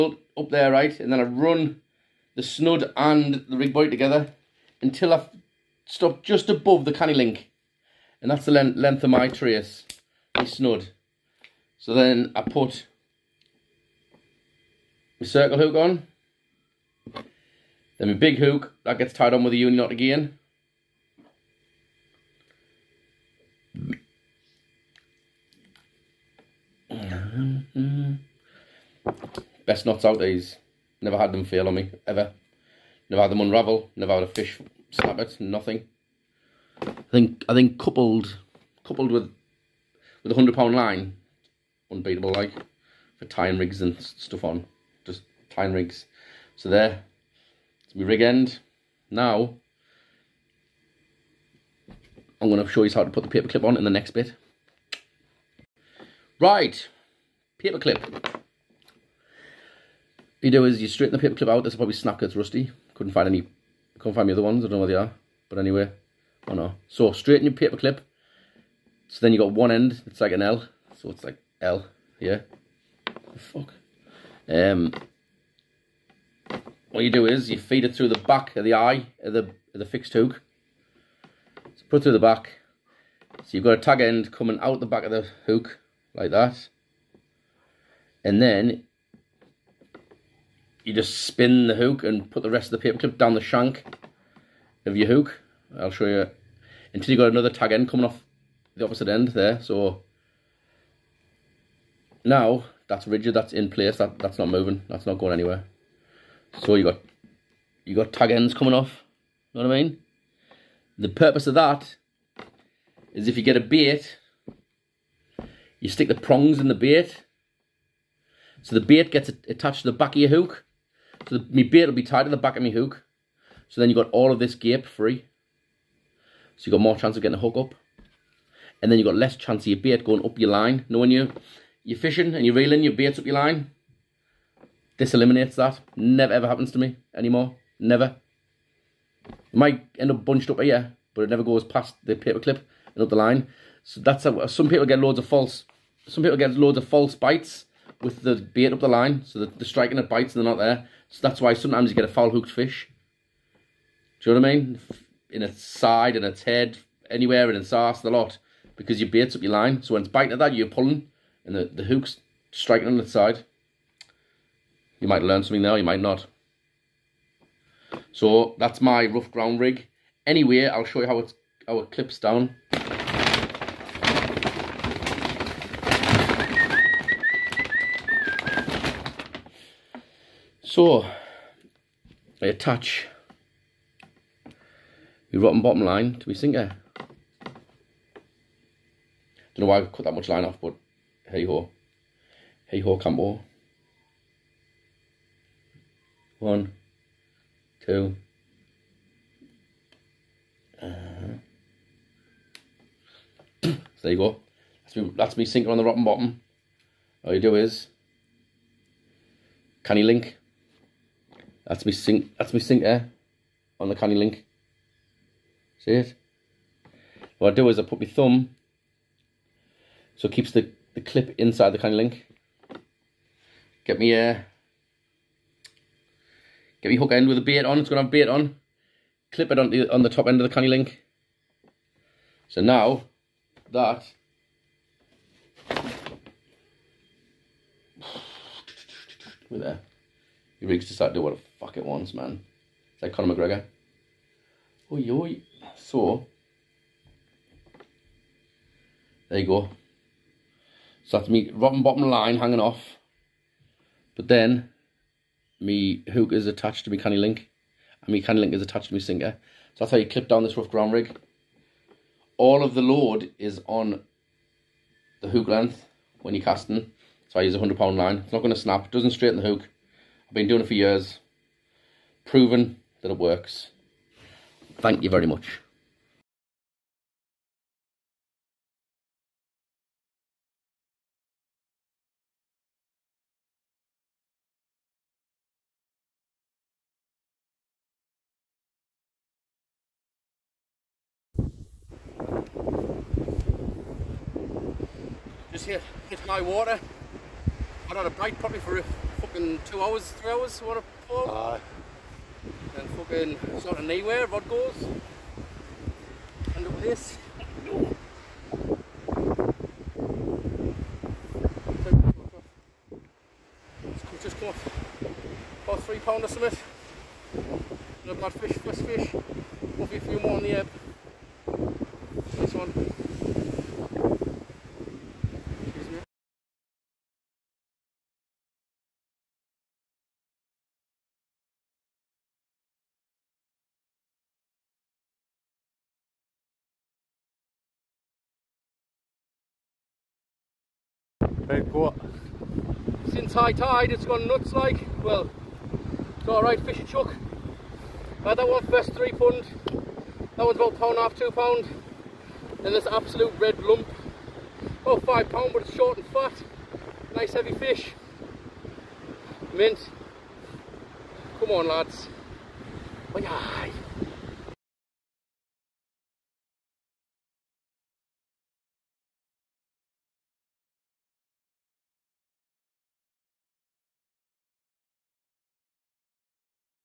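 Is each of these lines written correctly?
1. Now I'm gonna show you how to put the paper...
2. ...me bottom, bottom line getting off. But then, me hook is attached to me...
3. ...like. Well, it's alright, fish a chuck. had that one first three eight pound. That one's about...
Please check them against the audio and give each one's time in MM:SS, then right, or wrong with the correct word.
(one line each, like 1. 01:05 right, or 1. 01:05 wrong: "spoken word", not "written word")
1. 00:49 right
2. 04:11 wrong: "hanging", not "getting"
3. 05:44 wrong: "three", not "eight".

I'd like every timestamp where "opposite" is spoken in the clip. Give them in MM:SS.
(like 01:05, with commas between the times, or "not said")
01:38.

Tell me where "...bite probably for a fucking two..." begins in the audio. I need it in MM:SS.
04:58.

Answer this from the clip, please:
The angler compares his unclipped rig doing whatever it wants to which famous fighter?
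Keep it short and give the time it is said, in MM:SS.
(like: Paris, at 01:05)
Conor McGregor, at 04:03.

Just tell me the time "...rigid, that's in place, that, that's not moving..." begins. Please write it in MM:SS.
01:43.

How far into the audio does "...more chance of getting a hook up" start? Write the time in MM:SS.
02:06.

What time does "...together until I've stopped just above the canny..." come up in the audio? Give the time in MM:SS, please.
00:03.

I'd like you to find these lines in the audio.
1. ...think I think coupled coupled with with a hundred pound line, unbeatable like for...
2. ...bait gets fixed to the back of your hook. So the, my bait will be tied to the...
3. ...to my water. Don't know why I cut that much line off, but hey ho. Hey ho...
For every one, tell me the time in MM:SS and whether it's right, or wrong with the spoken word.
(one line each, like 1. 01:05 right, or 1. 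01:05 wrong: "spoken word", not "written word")
1. 00:37 right
2. 01:58 wrong: "attached", not "fixed"
3. 03:06 wrong: "sinker", not "water".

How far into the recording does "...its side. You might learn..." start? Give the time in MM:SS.
02:42.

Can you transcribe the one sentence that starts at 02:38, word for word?
Because you baits up your line.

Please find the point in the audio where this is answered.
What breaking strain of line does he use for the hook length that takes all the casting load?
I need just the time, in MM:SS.
04:27.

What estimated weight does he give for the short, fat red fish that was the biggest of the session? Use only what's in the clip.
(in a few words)
5 pound.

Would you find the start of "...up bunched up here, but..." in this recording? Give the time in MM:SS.
02:20.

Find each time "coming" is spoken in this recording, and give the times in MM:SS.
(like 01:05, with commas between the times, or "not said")
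01:24, 01:37, 01:48.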